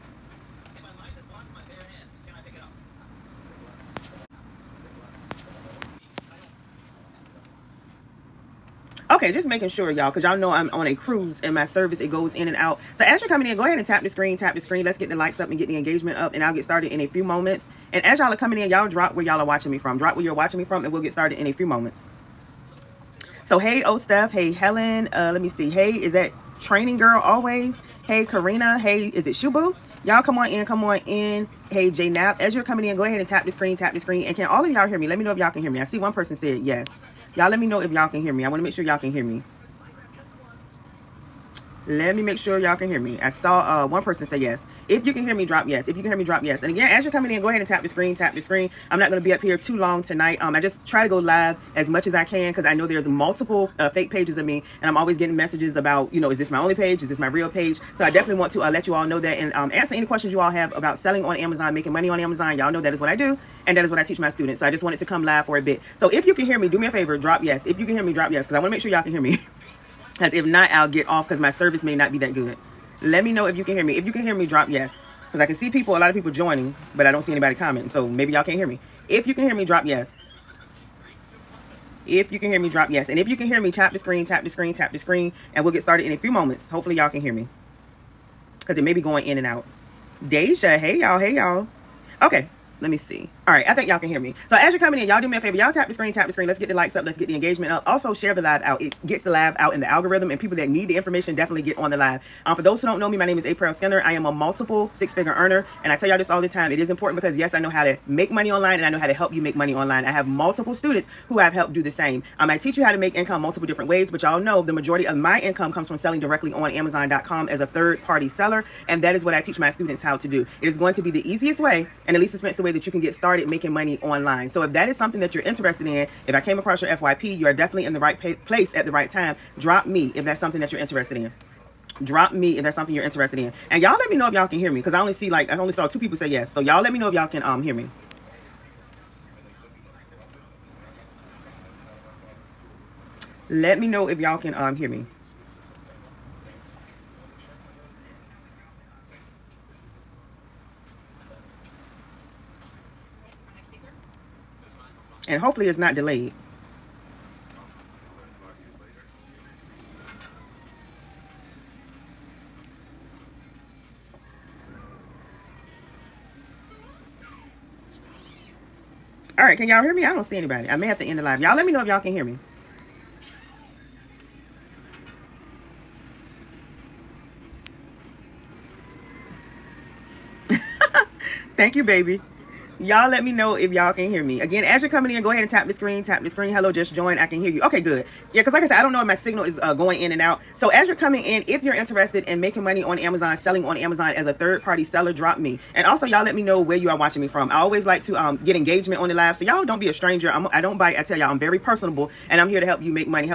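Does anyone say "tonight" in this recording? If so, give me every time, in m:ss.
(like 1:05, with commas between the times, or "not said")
0:50.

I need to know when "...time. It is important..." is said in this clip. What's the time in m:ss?
1:46.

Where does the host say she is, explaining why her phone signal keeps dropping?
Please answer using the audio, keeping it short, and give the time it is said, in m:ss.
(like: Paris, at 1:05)
On a cruise, at 0:10.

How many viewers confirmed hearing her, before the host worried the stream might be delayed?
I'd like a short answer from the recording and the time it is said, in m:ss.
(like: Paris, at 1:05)
2, at 2:15.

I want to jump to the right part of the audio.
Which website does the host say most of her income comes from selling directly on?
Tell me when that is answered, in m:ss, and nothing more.
1:56.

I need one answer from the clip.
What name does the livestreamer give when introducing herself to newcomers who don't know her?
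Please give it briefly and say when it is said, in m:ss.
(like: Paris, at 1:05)
Aprell Skinner, at 1:43.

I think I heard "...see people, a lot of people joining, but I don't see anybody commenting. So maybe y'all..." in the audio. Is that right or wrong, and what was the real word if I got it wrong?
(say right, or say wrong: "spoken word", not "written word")
right.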